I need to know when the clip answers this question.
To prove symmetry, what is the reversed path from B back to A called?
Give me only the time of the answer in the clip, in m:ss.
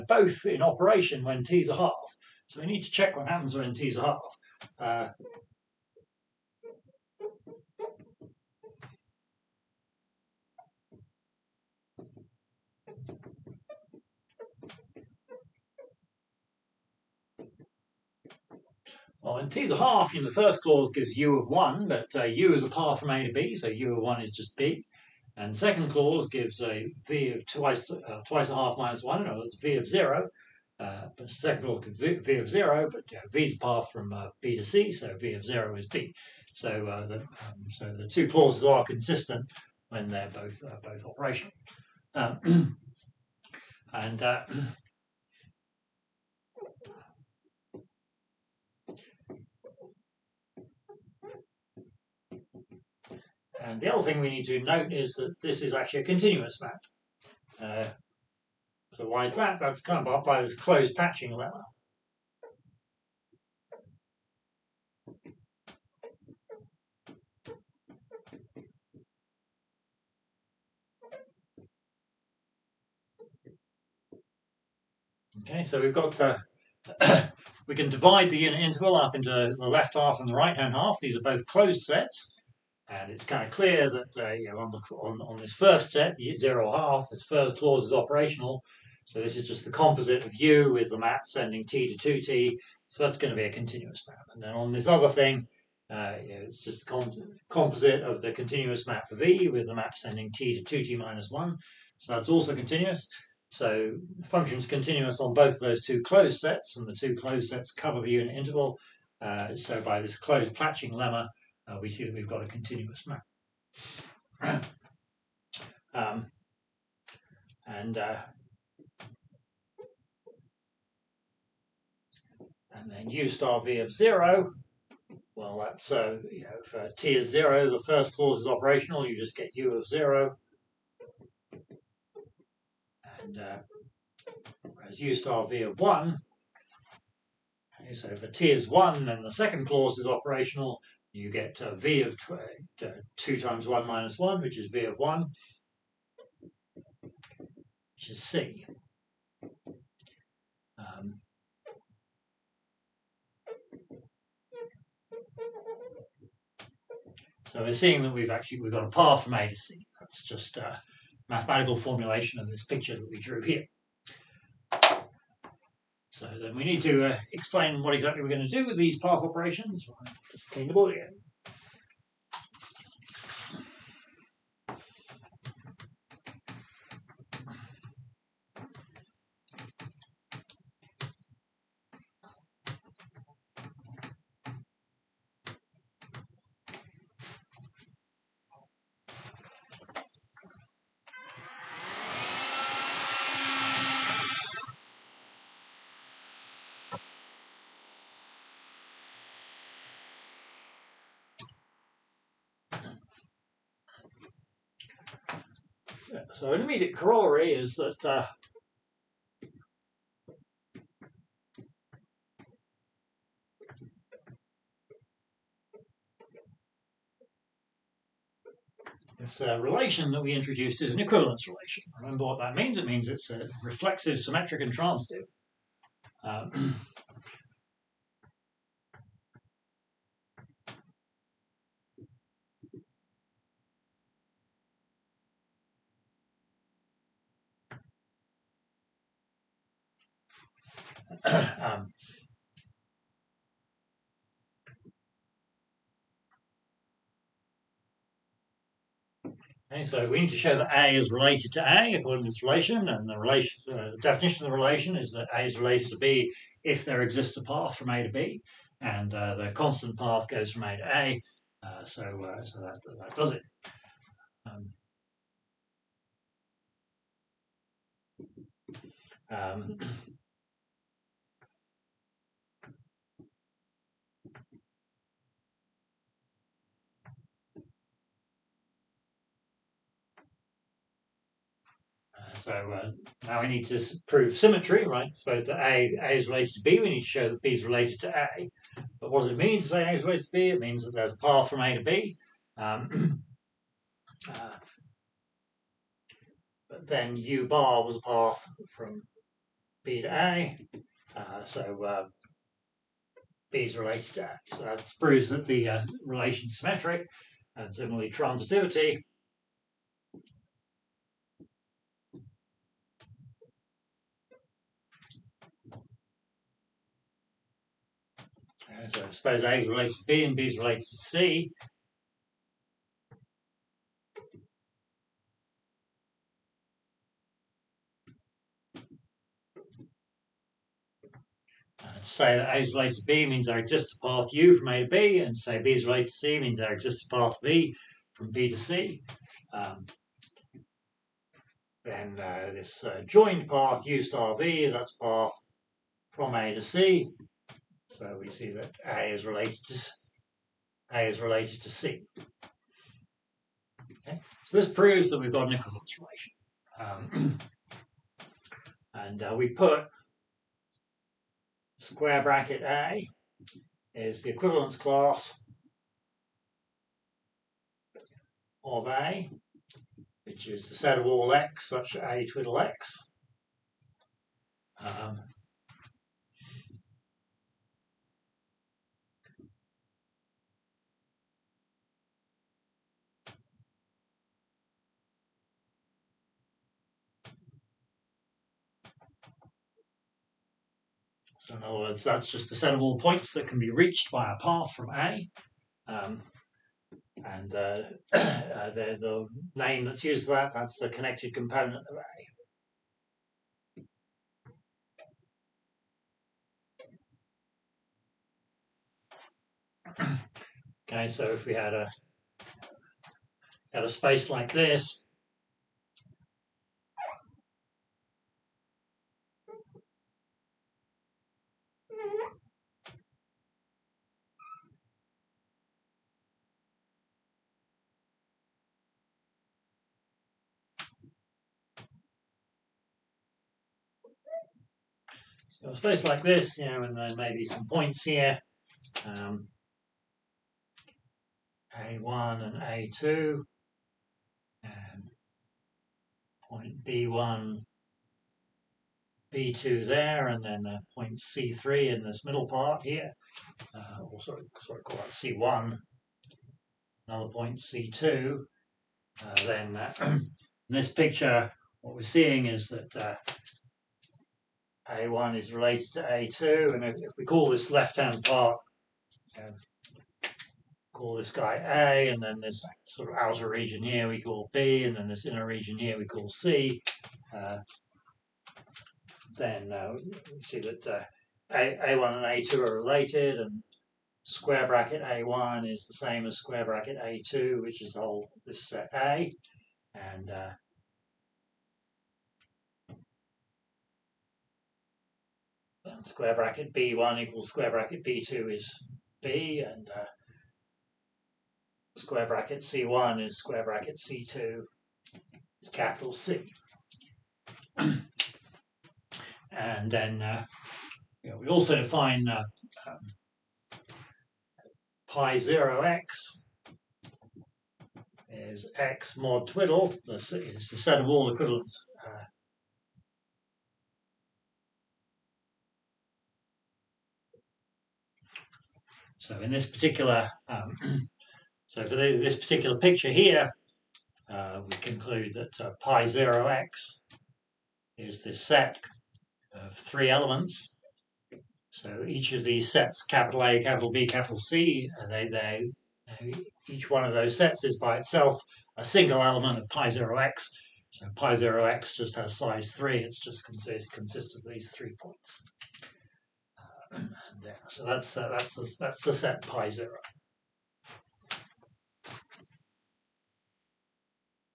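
4:57.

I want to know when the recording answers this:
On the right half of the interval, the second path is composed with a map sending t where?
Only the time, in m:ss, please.
1:40.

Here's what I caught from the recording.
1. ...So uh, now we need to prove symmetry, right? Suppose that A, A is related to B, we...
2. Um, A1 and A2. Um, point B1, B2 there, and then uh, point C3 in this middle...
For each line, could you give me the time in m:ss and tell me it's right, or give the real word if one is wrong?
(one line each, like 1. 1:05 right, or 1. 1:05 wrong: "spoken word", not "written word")
1. 4:42 right
2. 7:19 right.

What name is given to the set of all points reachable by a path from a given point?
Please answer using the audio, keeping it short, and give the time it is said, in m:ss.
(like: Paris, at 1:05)
connected component, at 6:40.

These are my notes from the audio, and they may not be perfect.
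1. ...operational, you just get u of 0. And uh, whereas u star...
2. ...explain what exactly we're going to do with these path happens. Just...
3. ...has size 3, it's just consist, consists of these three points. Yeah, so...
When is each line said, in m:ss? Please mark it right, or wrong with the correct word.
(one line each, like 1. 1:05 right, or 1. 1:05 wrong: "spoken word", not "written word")
1. 2:08 right
2. 2:47 wrong: "operations", not "happens"
3. 9:12 right.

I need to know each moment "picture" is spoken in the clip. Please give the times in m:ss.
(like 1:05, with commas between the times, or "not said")
2:42, 7:40, 8:52.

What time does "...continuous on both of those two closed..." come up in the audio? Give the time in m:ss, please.
1:44.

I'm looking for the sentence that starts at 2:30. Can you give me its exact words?
Um, so we're seeing that we've actually we've got a path from A to C.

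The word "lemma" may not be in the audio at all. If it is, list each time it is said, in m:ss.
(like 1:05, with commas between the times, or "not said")
1:01, 1:50.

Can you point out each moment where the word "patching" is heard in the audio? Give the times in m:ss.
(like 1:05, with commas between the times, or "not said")
1:00, 1:50.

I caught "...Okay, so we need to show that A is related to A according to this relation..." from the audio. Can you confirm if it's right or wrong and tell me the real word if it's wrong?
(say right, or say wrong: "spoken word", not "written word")
right.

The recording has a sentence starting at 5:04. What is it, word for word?
So that proves that the uh, relation is symmetric.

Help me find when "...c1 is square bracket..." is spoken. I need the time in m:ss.
8:22.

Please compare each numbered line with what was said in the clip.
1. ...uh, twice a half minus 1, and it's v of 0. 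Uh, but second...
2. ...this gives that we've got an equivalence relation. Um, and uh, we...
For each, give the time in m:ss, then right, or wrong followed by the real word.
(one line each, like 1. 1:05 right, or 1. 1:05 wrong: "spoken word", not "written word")
1. 0:27 right
2. 5:54 wrong: "proves", not "gives".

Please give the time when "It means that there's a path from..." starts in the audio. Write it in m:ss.
4:50.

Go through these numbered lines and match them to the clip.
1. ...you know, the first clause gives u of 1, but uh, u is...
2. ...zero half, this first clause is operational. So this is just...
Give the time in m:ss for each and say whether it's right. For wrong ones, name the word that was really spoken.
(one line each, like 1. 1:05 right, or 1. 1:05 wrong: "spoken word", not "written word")
1. 0:20 right
2. 1:26 right.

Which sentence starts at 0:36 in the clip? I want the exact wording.
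So, uh, the, um, so the two clauses are consistent when they're both, uh, both operational.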